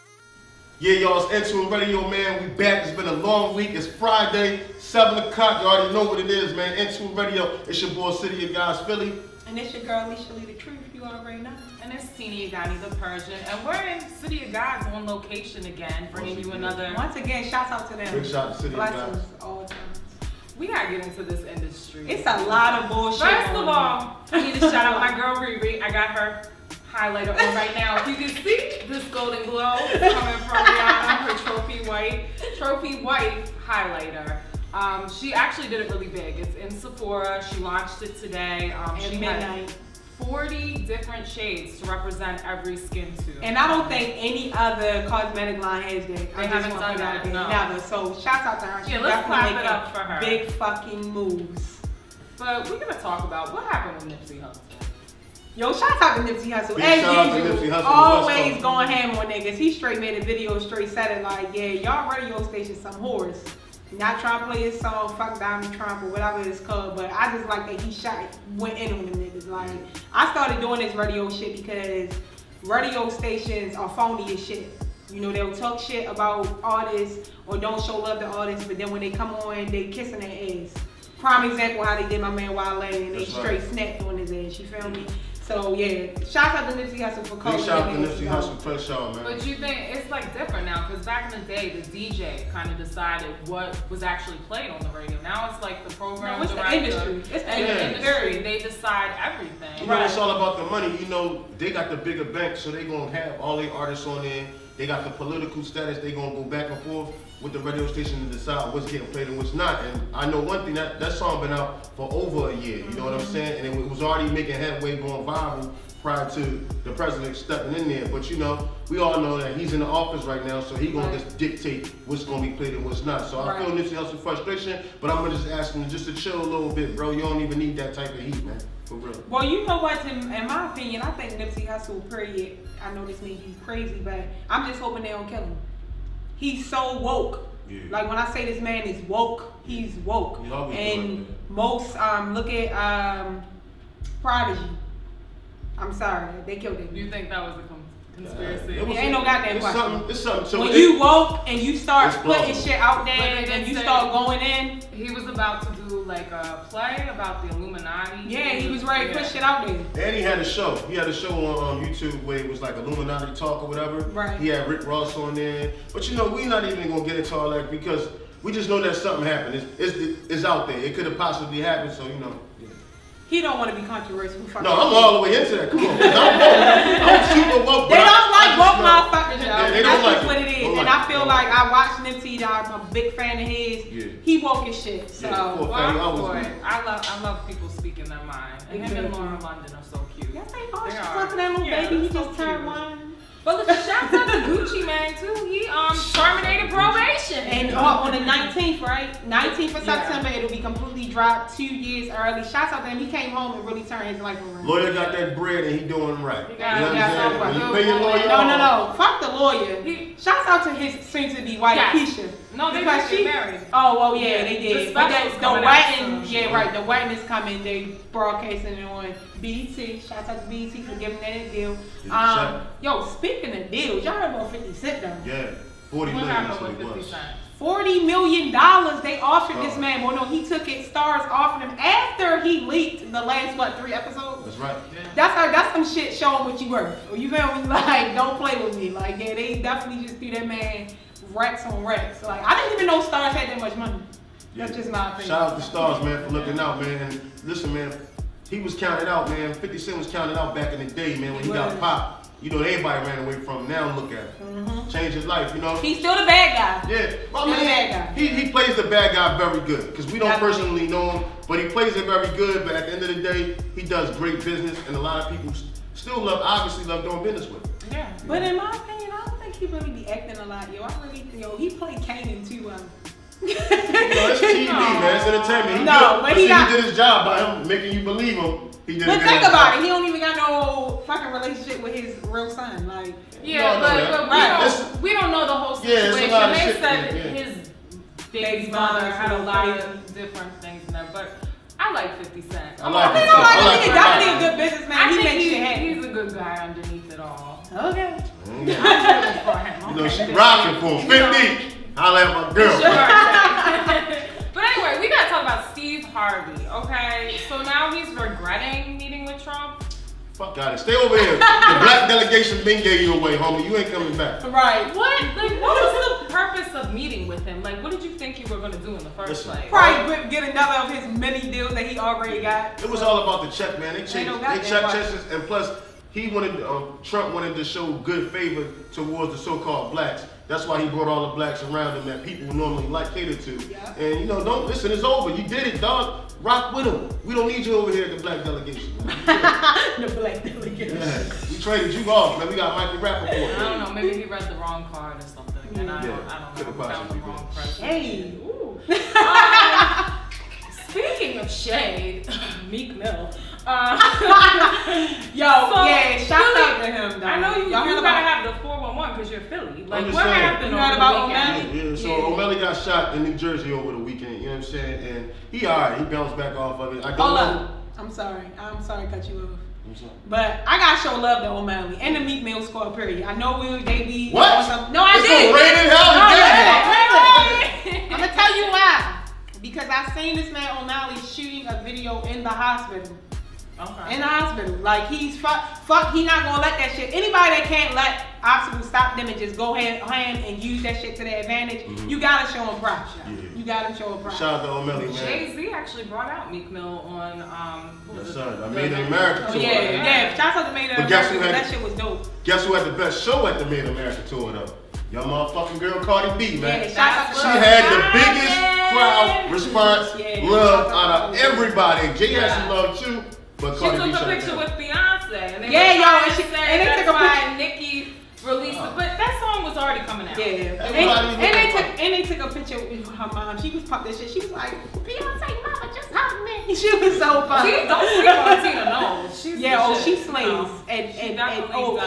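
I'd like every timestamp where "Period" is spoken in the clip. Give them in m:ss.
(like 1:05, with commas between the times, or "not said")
2:12, 6:12.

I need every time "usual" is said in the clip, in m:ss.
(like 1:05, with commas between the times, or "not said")
0:57.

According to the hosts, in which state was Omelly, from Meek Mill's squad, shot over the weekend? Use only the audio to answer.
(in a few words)
New Jersey.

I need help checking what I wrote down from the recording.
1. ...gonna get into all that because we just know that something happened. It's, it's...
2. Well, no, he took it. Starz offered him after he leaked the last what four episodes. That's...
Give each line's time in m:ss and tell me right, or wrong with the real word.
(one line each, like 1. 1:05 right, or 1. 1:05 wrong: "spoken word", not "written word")
1. 2:46 right
2. 3:50 wrong: "three", not "four".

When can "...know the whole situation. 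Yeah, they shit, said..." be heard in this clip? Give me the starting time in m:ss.
4:45.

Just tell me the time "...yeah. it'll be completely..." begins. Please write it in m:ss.
3:20.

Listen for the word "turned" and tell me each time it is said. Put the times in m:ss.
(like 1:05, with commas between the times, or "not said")
3:12, 3:23.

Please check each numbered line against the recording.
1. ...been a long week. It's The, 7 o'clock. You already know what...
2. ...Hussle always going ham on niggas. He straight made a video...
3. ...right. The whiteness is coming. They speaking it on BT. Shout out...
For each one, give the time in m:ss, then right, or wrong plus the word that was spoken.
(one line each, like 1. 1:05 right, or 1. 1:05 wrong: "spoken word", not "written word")
1. 0:02 wrong: "Friday", not "The"
2. 0:57 right
3. 3:36 wrong: "broadcasting", not "speaking".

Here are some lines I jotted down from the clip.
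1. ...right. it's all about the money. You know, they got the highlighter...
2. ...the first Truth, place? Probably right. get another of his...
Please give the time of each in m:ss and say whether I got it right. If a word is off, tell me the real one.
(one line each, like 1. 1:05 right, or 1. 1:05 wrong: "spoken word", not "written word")
1. 1:39 wrong: "bigger", not "highlighter"
2. 5:19 wrong: "Listen", not "Truth".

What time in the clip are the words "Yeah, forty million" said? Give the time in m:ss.
3:45.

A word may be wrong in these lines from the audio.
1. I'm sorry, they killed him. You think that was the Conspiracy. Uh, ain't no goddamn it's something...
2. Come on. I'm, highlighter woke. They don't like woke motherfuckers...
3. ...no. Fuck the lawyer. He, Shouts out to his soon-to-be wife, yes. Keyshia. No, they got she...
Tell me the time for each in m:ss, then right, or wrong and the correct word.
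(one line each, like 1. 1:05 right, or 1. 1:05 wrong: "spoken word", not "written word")
1. 2:25 right
2. 2:55 wrong: "super", not "highlighter"
3. 3:28 right.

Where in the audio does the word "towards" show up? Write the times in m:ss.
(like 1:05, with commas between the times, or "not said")
5:28.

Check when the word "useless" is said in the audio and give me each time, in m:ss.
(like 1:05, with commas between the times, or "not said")
not said.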